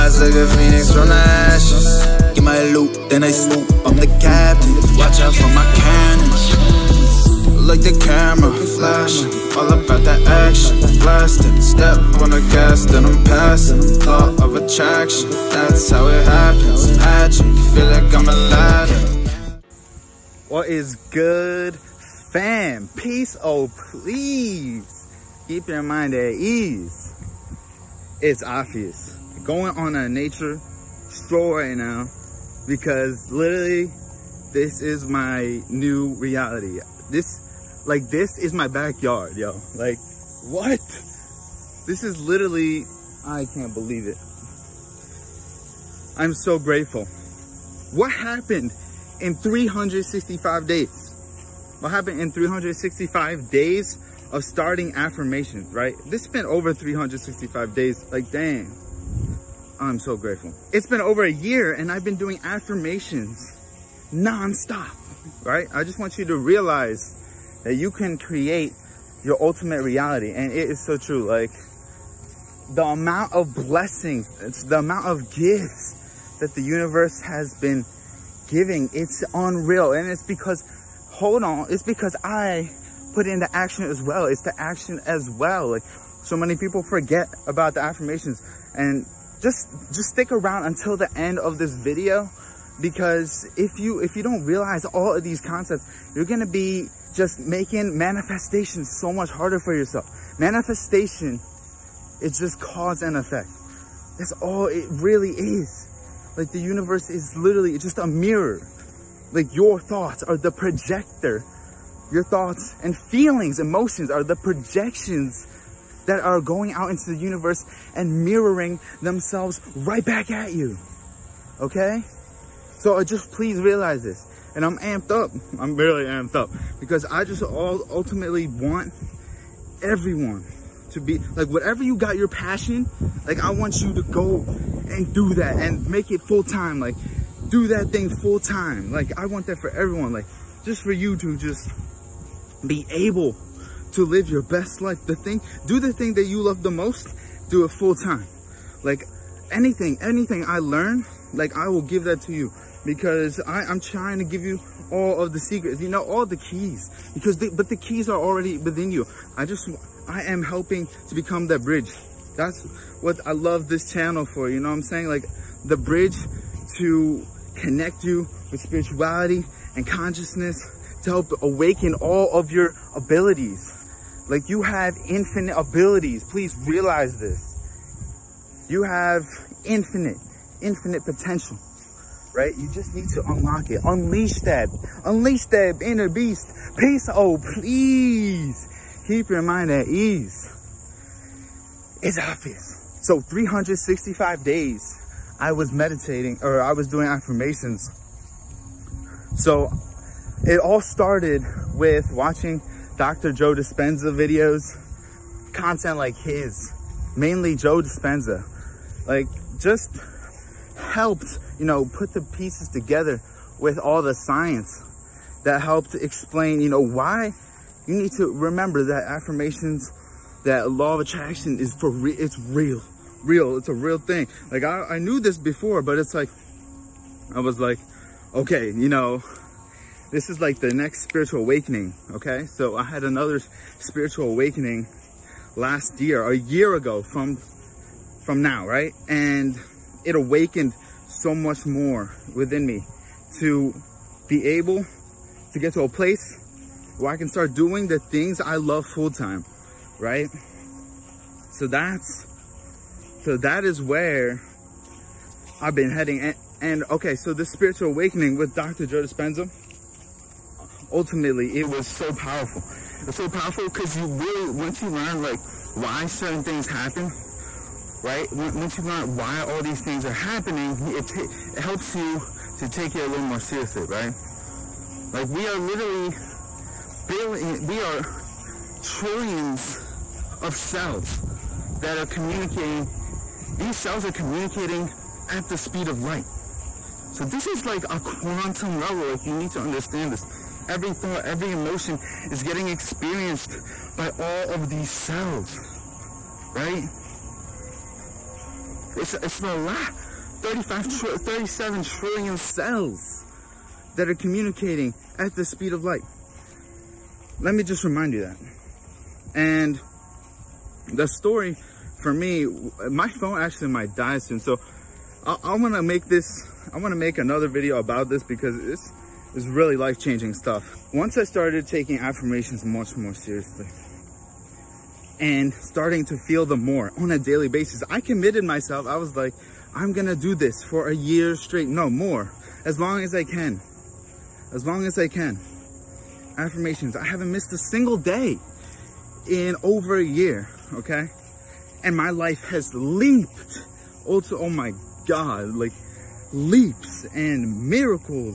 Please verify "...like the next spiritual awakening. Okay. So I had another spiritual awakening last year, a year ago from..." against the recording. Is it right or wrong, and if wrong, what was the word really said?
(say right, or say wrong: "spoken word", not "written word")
right.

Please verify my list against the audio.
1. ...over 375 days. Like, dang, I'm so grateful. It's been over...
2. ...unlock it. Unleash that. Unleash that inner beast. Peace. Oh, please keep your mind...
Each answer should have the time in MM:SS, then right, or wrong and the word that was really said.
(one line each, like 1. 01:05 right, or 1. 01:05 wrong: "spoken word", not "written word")
1. 00:56 wrong: "365", not "375"
2. 03:03 right.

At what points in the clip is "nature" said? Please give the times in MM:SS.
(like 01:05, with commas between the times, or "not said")
00:30.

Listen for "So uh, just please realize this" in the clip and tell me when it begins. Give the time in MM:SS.
02:02.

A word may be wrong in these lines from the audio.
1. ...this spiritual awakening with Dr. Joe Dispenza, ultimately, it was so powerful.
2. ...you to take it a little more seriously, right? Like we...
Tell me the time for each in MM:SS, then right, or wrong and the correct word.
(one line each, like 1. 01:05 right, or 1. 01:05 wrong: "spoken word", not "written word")
1. 04:17 right
2. 04:31 right.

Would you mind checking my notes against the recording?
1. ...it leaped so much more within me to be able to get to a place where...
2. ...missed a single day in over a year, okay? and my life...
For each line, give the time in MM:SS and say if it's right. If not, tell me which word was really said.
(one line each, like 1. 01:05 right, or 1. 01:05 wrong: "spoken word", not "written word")
1. 04:00 wrong: "awakened", not "leaped"
2. 05:37 right.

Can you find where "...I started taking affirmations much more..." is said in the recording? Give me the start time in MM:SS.
05:21.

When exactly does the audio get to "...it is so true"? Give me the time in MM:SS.
01:10.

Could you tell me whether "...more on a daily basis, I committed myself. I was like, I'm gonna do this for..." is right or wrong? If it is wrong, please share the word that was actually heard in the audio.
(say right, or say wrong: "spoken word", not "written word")
right.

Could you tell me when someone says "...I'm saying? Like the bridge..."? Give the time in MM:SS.
02:44.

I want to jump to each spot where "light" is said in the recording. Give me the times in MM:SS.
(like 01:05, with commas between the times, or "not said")
04:46, 05:05.